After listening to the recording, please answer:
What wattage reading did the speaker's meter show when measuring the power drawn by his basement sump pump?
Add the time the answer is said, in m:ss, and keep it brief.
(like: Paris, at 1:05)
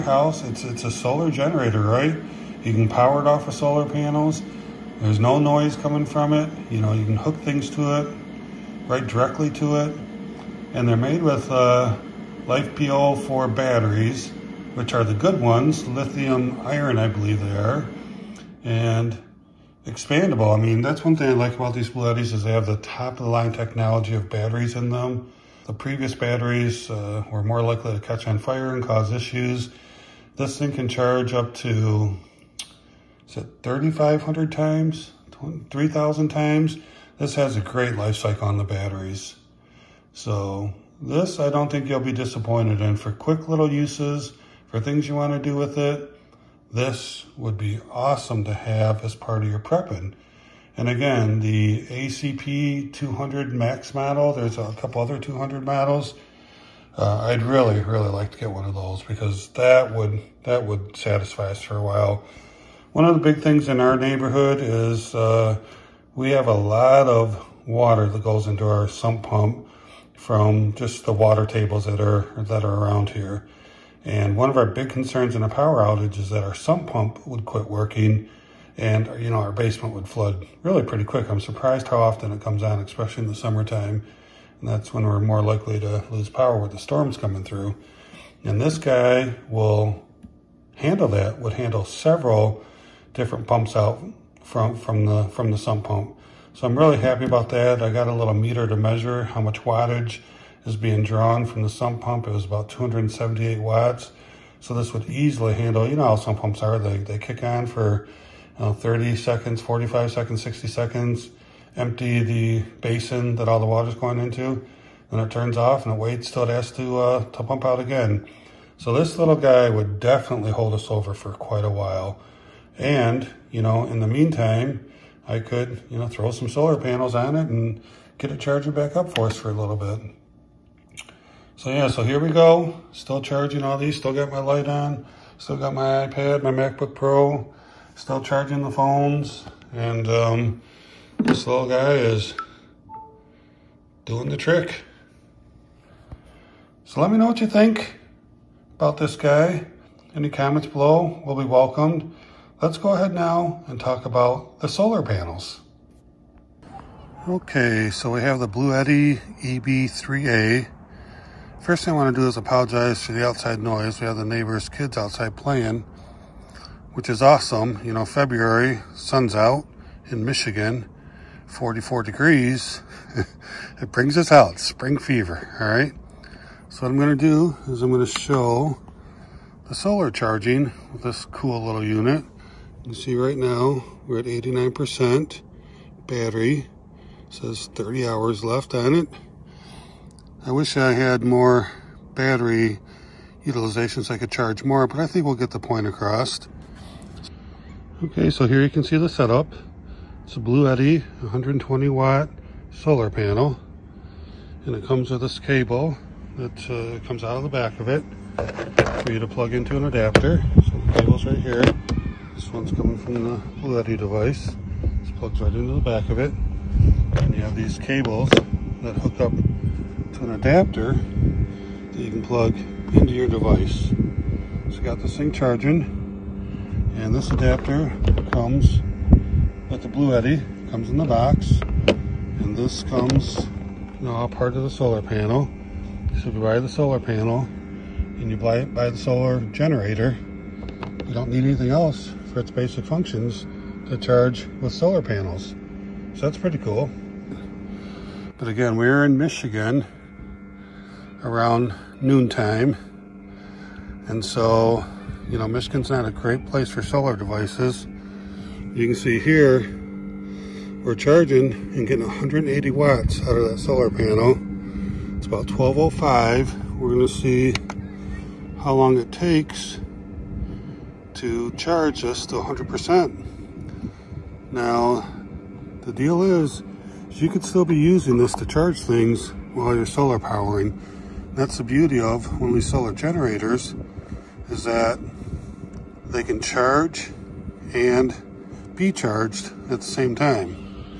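278 watts, at 1:42.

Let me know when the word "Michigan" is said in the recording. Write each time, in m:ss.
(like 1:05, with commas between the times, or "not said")
2:50, 4:09, 4:15.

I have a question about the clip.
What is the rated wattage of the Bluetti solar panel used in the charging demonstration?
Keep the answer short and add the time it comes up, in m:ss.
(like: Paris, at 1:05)
120 watt, at 3:21.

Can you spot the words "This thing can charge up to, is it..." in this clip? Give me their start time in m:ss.
0:30.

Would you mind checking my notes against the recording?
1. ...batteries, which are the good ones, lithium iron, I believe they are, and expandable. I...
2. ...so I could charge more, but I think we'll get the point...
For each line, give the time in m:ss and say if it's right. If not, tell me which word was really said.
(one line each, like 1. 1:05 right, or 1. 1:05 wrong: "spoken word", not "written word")
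1. 0:13 right
2. 3:14 right.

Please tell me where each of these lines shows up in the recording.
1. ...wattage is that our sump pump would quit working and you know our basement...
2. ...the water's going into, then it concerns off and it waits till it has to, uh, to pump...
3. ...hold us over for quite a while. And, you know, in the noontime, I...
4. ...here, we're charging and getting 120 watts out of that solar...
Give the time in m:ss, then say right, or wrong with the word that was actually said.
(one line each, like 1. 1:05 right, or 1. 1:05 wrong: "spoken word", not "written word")
1. 1:15 wrong: "outage", not "wattage"
2. 1:53 wrong: "turns", not "concerns"
3. 2:00 wrong: "meantime", not "noontime"
4. 4:19 wrong: "180", not "120".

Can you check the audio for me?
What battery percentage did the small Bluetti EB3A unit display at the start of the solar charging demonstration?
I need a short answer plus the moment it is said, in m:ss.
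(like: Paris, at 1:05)
89%, at 3:04.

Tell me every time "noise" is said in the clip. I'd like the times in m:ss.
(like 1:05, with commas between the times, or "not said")
0:05, 2:43.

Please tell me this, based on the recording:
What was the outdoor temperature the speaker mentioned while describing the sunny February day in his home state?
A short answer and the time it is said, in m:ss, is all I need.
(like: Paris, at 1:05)
44 degrees, at 2:51.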